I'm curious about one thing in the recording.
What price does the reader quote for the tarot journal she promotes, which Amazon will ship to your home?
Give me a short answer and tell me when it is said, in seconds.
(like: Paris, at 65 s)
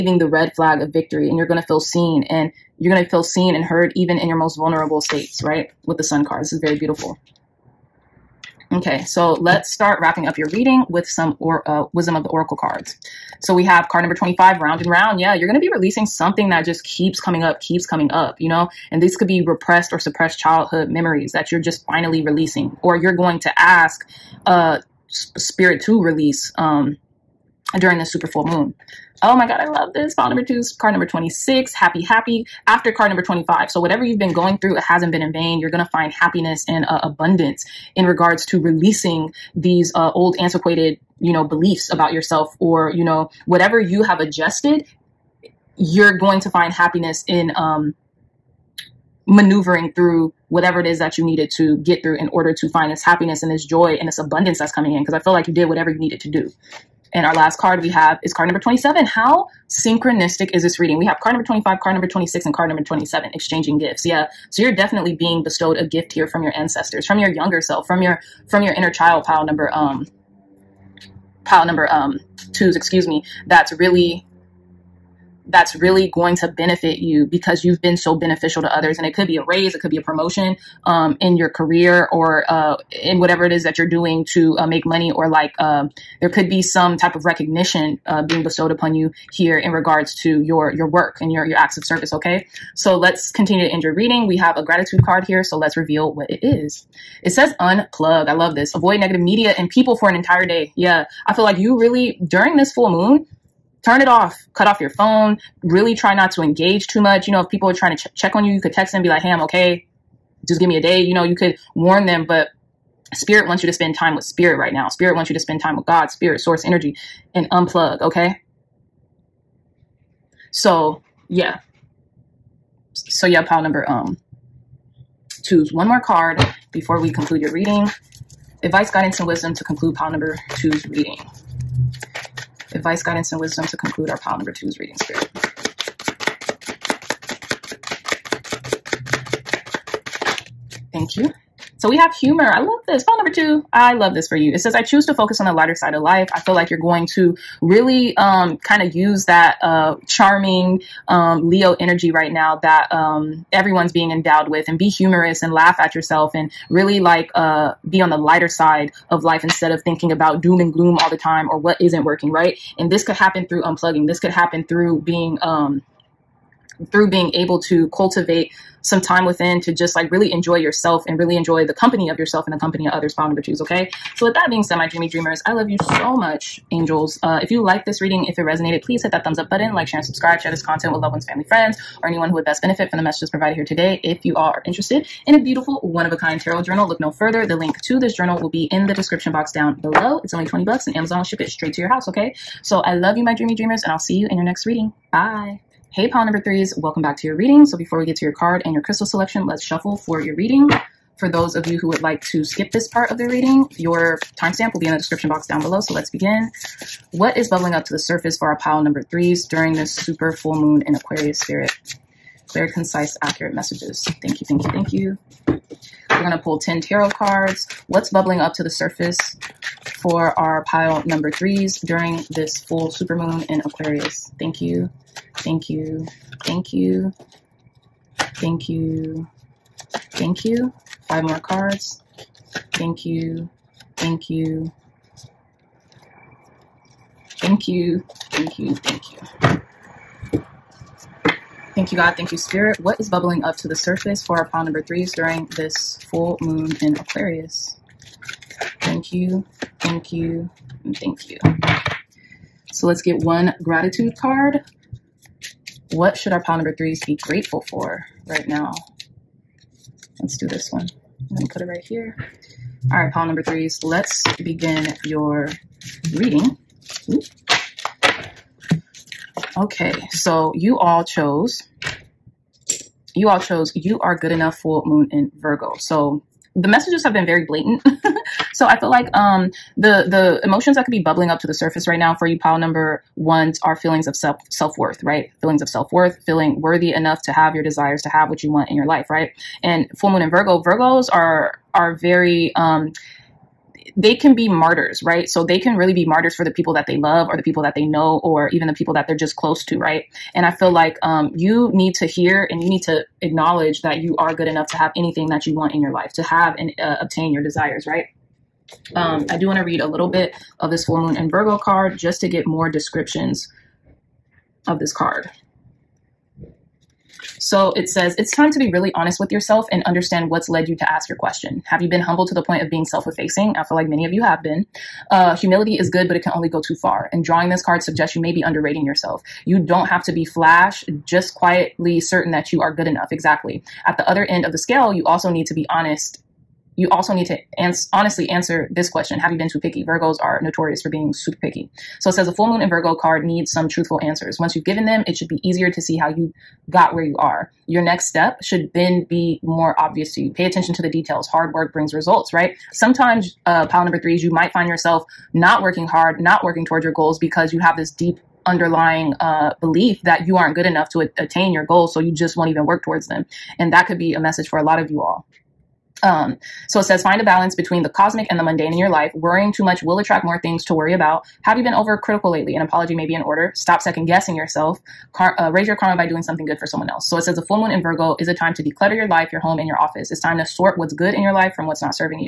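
$20, at 190 s.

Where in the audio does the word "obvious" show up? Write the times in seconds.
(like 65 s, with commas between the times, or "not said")
349 s.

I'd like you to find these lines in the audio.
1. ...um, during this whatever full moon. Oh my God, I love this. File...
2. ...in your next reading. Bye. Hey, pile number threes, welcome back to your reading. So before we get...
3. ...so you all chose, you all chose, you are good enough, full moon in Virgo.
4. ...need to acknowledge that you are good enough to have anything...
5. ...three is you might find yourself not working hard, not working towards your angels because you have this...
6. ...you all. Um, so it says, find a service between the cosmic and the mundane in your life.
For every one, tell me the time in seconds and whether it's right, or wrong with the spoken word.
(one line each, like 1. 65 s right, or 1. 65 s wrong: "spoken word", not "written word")
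1. 26 s wrong: "super", not "whatever"
2. 194 s right
3. 270 s right
4. 302 s right
5. 354 s wrong: "goals", not "angels"
6. 364 s wrong: "balance", not "service".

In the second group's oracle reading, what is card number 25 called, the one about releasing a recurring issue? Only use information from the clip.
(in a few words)
Round and round.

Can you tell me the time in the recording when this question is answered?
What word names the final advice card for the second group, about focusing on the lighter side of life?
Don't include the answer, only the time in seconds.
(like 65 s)
142 s.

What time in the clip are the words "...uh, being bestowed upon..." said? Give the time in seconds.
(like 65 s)
88 s.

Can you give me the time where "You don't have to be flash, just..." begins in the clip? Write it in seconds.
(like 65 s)
329 s.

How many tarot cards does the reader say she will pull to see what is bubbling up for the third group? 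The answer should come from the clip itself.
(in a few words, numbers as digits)
10.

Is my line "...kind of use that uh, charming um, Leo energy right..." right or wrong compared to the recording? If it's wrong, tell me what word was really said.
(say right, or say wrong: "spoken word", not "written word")
right.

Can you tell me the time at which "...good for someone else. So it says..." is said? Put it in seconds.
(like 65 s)
376 s.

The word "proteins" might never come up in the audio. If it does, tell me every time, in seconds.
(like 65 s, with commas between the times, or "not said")
not said.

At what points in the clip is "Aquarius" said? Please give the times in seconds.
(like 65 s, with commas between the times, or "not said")
210 s, 223 s, 246 s.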